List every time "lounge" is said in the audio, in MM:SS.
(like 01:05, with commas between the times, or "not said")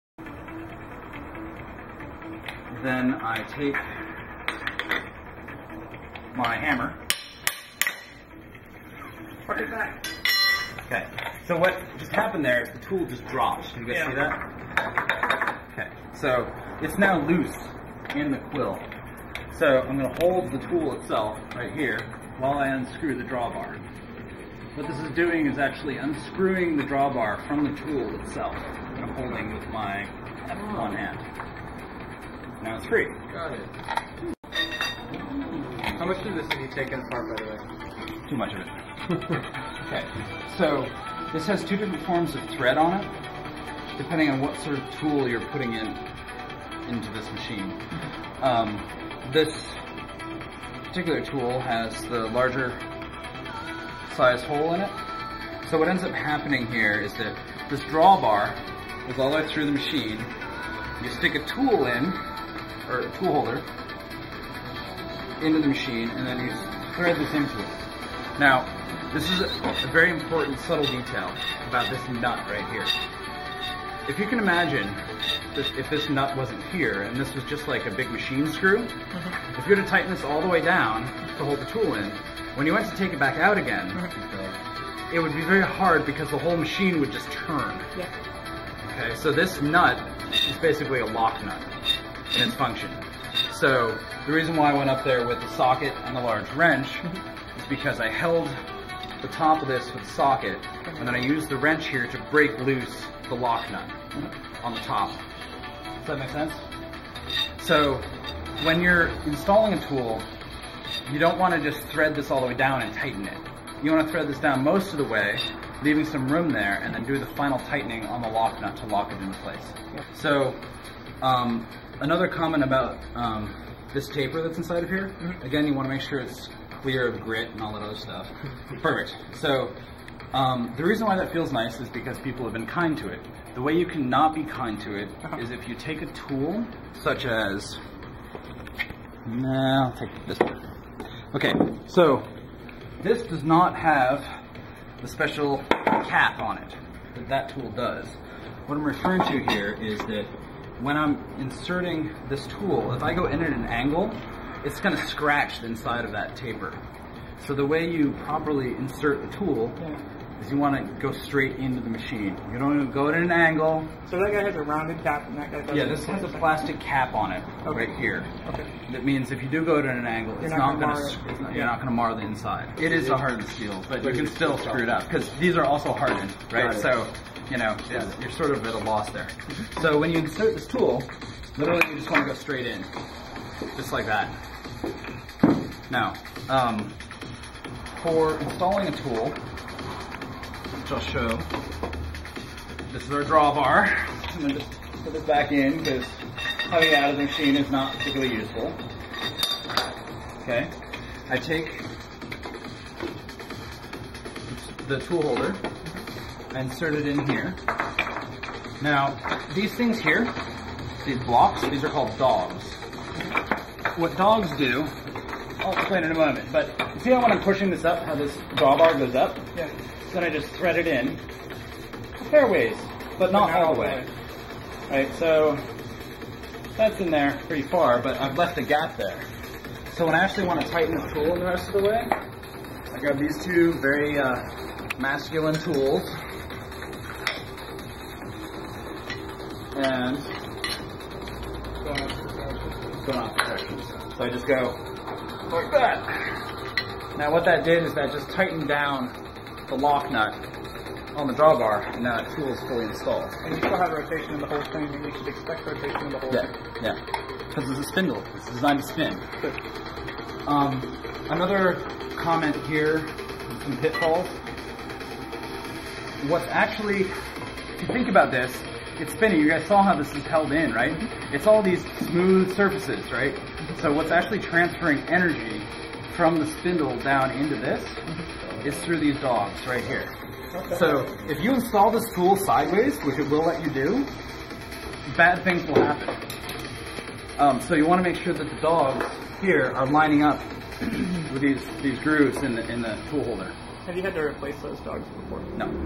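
not said.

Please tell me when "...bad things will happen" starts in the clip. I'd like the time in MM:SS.
04:45.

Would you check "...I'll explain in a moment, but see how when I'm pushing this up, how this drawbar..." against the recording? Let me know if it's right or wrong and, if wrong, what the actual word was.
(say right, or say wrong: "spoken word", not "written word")
right.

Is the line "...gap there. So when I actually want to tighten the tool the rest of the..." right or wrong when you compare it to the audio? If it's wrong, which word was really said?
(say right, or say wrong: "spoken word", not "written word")
right.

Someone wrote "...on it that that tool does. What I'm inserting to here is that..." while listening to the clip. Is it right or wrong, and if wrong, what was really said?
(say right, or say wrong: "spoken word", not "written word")
wrong: "referring", not "inserting".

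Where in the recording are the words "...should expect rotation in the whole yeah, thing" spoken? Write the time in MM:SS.
04:15.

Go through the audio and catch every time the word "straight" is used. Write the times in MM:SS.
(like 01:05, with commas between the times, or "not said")
02:41, 03:02.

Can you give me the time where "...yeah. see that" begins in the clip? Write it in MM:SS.
00:13.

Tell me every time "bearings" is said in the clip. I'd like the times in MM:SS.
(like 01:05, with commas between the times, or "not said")
not said.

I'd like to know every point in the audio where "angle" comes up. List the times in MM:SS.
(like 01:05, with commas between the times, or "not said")
02:33, 02:43, 02:50.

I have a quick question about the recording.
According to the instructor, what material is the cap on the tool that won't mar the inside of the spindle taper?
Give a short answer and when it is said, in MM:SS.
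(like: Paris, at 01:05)
plastic, at 02:46.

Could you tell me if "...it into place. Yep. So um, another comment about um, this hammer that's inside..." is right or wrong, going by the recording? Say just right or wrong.
wrong.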